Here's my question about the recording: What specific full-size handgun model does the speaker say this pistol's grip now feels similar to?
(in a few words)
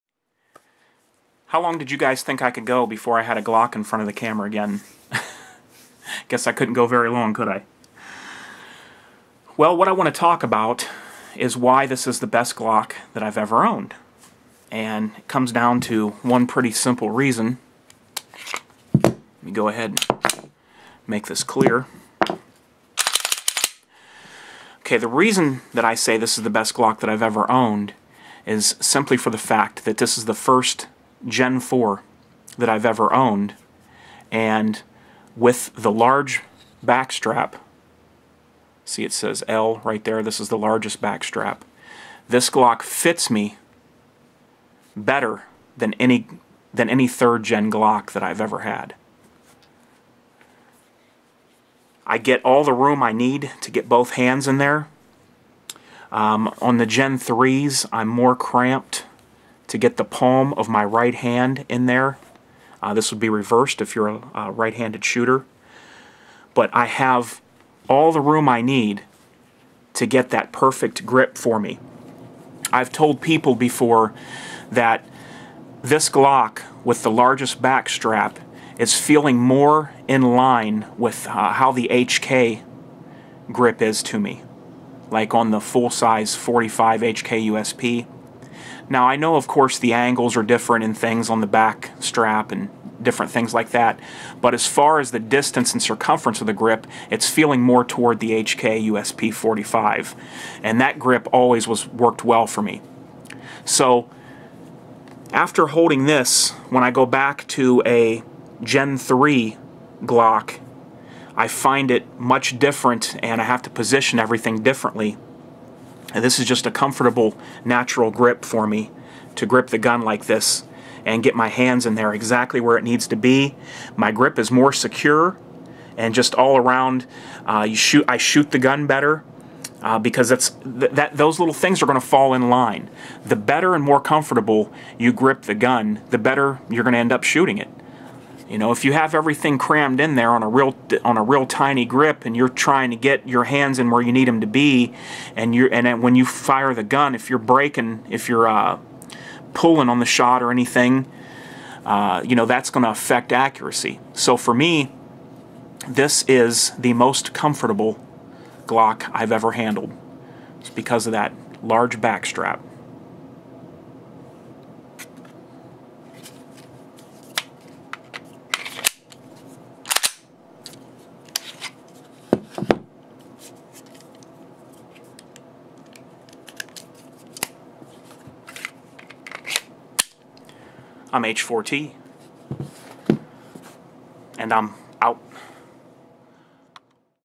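HK USP 45.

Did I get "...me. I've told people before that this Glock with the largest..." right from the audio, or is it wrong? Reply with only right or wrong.
right.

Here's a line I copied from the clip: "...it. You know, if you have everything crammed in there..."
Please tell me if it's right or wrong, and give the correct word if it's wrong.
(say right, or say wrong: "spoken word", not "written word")
right.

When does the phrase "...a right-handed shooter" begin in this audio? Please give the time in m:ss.
1:04.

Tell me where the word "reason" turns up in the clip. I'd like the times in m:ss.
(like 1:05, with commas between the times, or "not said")
0:17, 0:25.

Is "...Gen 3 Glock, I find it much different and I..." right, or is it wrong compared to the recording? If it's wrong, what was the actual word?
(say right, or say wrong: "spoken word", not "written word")
right.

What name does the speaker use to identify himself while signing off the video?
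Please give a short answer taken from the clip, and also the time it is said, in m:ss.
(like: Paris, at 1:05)
H4T, at 3:01.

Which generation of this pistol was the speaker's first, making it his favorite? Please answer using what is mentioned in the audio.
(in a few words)
Gen 4.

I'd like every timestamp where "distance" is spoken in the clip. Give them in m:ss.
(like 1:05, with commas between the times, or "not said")
1:35.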